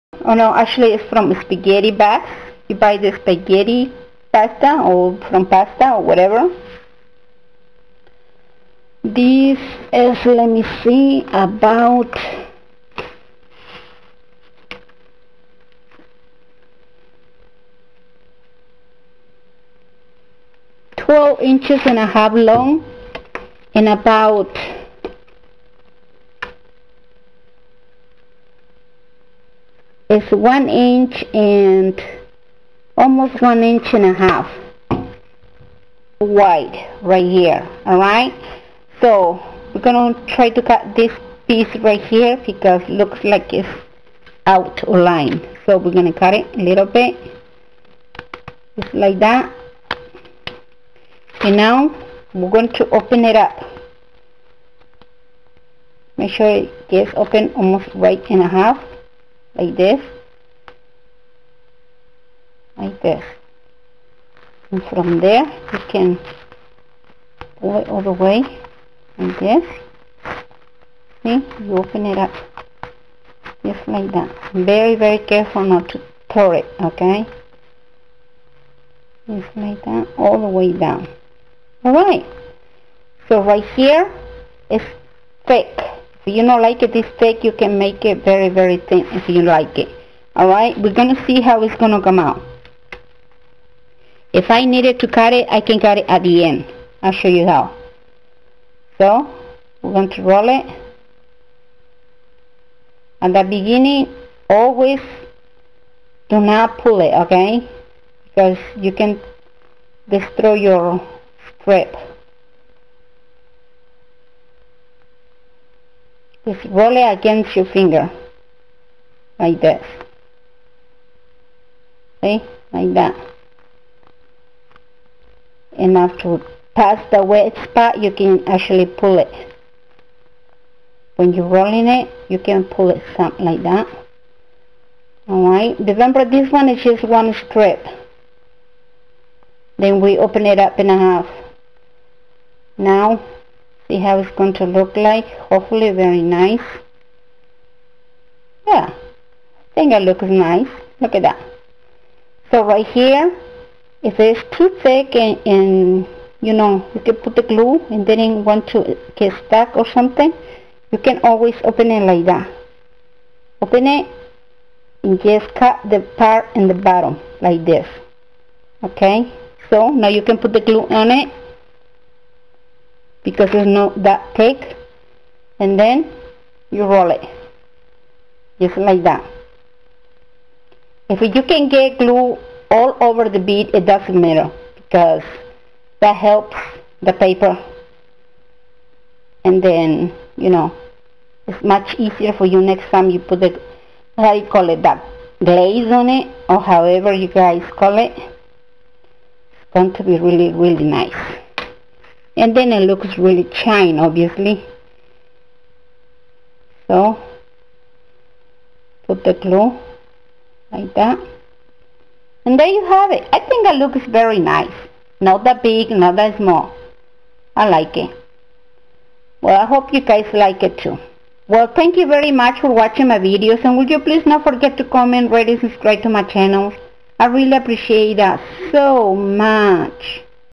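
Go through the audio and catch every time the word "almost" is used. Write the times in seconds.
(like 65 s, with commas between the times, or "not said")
32 s, 57 s.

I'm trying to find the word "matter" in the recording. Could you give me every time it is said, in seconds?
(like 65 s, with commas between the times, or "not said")
184 s.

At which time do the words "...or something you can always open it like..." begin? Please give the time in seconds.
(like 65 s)
159 s.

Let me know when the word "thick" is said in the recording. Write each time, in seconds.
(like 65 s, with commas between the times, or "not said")
85 s, 154 s.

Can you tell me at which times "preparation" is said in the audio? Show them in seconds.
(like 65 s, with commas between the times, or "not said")
not said.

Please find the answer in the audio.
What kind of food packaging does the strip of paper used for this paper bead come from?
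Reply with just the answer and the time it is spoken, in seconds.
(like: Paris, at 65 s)
Spaghetti bag, at 1 s.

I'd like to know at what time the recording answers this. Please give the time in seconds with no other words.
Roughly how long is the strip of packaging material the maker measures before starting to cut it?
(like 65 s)
20 s.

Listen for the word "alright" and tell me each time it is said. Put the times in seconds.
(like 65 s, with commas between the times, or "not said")
37 s, 90 s, 135 s.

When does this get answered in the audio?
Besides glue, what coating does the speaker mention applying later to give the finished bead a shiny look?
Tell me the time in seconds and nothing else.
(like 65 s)
195 s.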